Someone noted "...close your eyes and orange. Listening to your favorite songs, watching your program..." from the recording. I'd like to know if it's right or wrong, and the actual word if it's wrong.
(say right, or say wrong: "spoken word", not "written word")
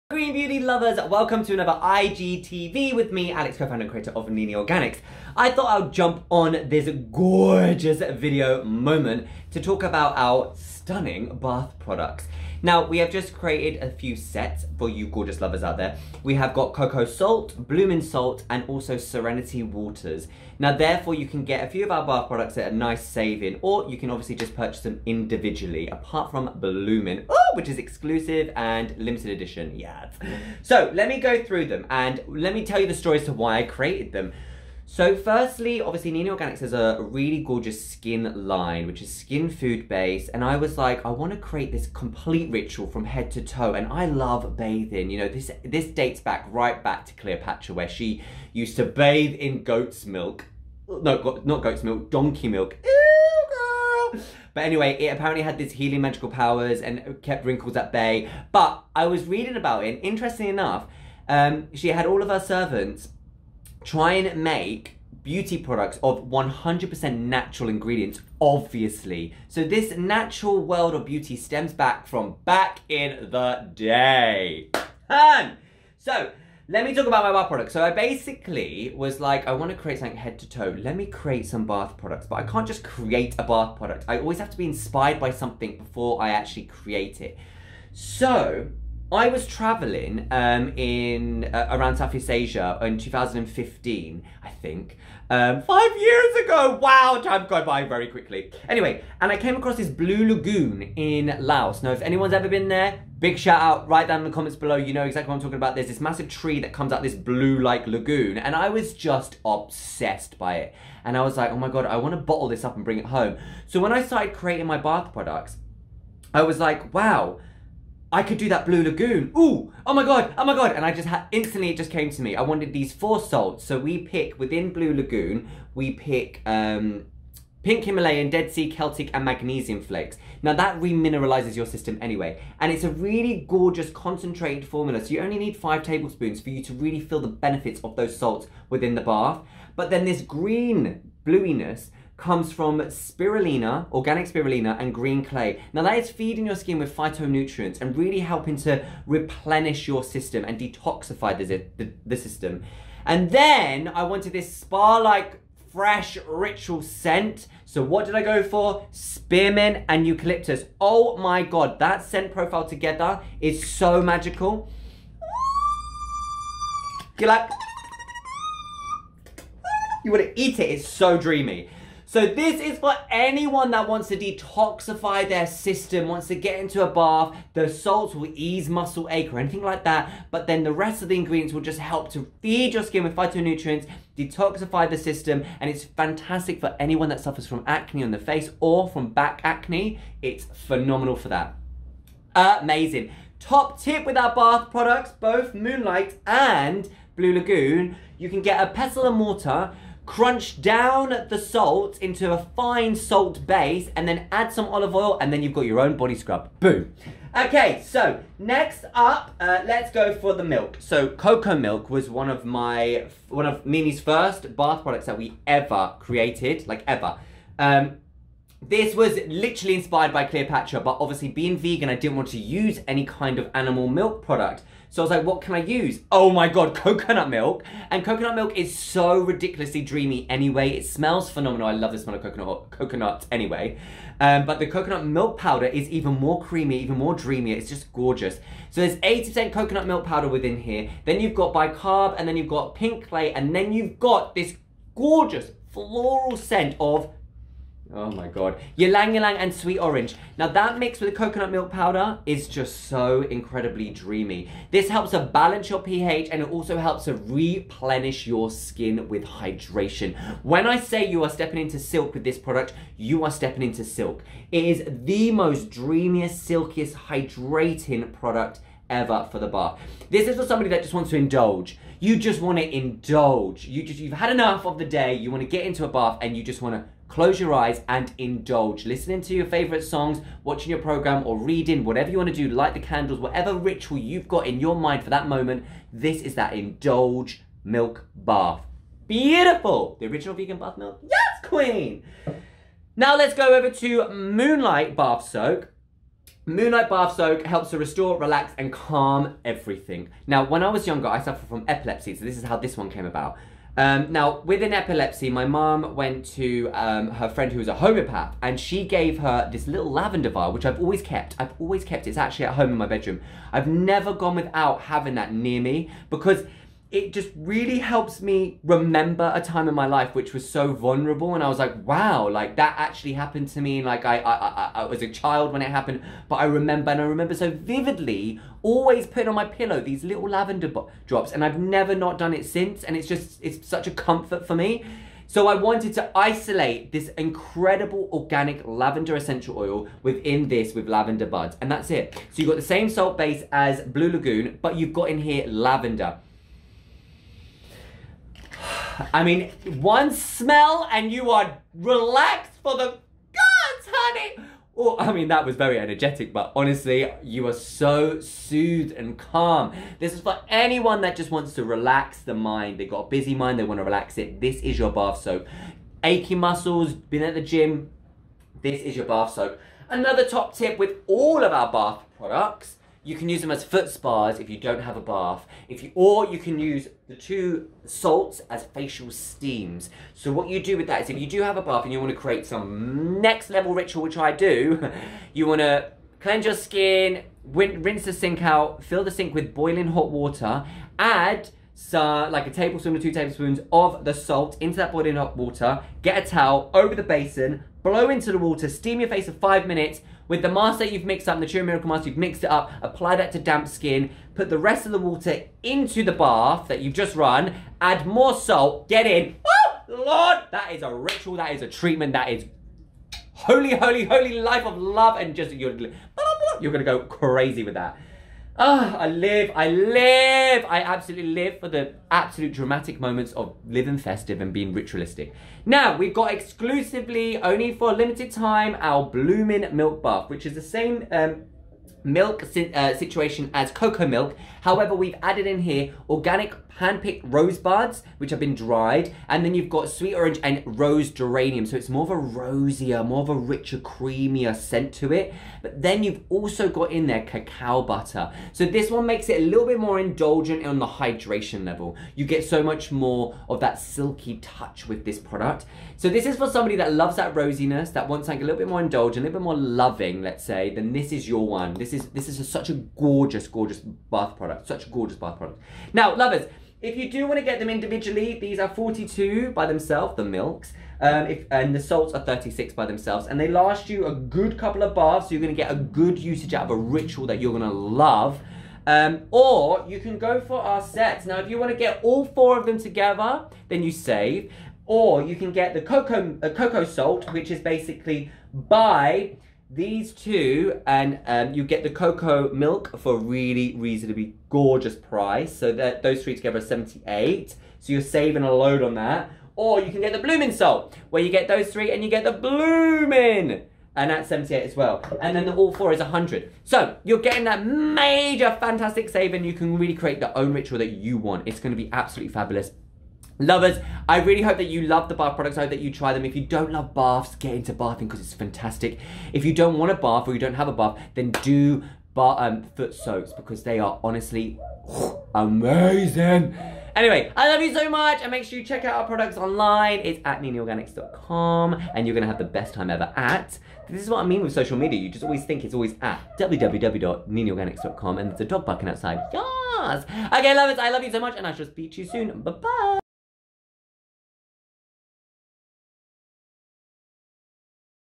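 wrong: "indulge", not "orange".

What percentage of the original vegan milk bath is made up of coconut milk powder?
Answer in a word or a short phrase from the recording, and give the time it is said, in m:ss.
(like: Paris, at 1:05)
80%, at 3:58.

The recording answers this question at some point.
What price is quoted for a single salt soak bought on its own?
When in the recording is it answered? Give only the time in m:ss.
7:52.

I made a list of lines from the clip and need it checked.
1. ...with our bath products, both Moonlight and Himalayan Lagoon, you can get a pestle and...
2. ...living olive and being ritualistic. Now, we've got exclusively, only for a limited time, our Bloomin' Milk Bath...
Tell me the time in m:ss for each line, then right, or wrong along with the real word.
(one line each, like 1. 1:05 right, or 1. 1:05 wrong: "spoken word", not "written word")
1. 3:14 wrong: "Blue", not "Himalayan"
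2. 7:03 wrong: "festive", not "olive".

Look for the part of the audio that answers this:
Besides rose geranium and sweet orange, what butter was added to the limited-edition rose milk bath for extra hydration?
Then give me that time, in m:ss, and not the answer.
7:27.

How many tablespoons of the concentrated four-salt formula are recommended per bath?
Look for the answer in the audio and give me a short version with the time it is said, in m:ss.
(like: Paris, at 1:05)
5, at 2:15.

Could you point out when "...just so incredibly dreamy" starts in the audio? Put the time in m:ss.
4:12.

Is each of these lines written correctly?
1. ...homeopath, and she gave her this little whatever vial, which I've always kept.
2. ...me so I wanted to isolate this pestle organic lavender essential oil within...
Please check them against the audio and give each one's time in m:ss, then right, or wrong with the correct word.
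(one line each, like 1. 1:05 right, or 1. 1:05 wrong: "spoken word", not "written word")
1. 5:07 wrong: "lavender", not "whatever"
2. 5:34 wrong: "incredible", not "pestle".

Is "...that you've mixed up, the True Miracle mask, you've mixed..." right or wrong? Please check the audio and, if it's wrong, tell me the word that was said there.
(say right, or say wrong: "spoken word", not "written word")
right.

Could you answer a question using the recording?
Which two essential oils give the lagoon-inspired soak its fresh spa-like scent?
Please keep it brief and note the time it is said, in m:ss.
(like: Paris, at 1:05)
Spearmint and eucalyptus, at 2:38.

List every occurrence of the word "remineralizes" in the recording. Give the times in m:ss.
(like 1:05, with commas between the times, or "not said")
2:10.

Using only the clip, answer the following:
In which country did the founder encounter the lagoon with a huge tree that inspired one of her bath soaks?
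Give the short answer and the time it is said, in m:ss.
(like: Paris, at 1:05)
Laos, at 1:41.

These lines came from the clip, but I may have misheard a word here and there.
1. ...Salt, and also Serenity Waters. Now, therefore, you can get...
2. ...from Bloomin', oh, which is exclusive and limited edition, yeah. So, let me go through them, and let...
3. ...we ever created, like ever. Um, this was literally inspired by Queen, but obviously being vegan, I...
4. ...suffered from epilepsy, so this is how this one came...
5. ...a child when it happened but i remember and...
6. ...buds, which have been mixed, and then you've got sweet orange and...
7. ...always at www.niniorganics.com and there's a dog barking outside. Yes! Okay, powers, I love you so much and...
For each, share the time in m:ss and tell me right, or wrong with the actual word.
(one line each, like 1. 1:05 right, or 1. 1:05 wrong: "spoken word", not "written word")
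1. 0:18 right
2. 0:26 right
3. 3:35 wrong: "Cleopatra", not "Queen"
4. 5:01 right
5. 5:25 right
6. 7:17 wrong: "dried", not "mixed"
7. 8:55 wrong: "lovers", not "powers".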